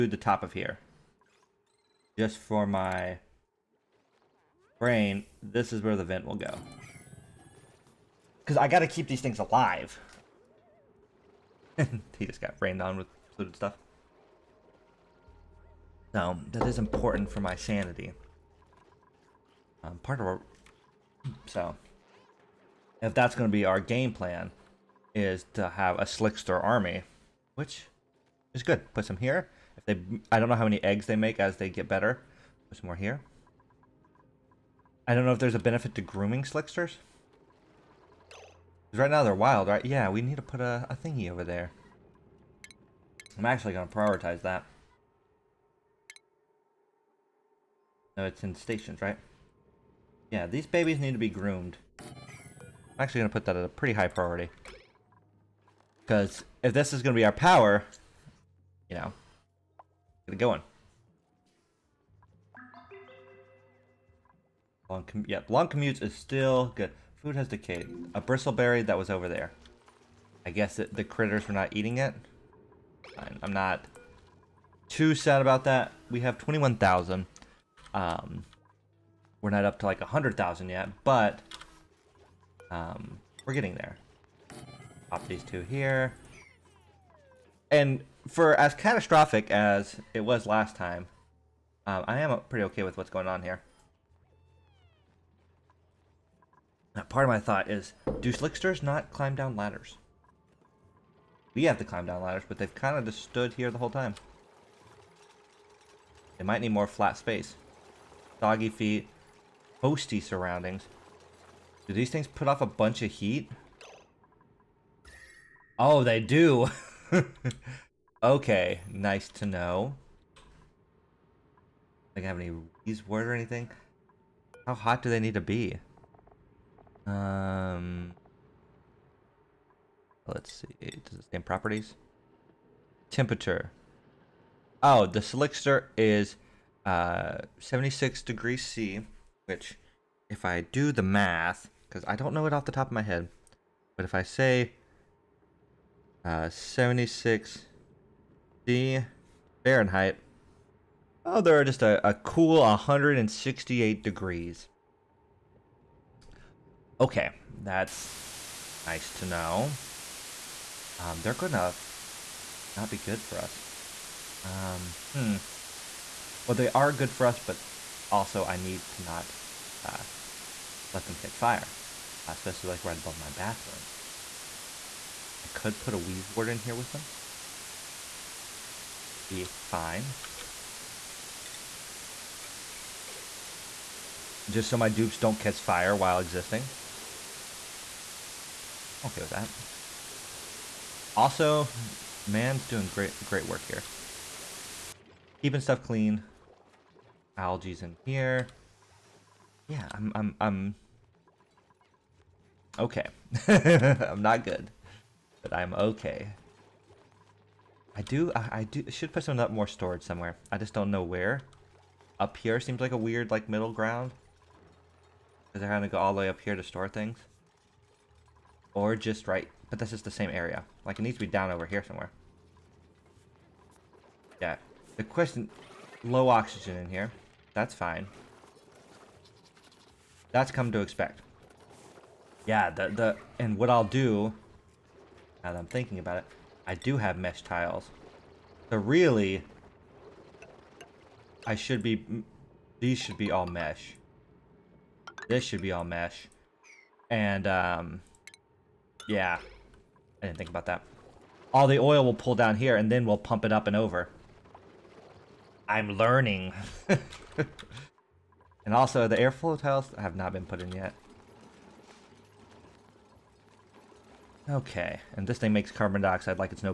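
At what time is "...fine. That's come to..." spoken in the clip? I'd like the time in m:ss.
3:47.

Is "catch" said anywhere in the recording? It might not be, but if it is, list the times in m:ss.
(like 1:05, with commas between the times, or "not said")
2:51, 3:05.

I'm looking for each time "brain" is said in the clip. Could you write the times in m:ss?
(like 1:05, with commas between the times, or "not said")
0:04.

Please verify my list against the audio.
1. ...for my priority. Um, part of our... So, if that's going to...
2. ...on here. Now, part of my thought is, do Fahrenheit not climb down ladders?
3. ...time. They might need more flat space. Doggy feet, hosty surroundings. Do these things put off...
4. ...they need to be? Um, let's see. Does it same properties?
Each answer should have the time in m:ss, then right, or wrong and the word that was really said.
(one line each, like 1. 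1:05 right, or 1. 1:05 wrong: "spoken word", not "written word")
1. 0:17 wrong: "sanity", not "priority"
2. 1:33 wrong: "Slicksters", not "Fahrenheit"
3. 1:43 right
4. 2:05 right.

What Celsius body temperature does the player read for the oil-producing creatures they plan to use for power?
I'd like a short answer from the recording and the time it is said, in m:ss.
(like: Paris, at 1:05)
76 degrees C, at 2:17.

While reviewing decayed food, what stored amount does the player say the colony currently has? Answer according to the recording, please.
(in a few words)
21,000.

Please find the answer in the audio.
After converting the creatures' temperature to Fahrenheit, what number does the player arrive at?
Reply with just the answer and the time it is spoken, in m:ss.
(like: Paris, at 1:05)
168 degrees, at 2:32.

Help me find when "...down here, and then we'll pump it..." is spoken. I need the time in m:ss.
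4:12.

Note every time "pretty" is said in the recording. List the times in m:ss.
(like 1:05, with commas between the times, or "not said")
0:53, 1:32.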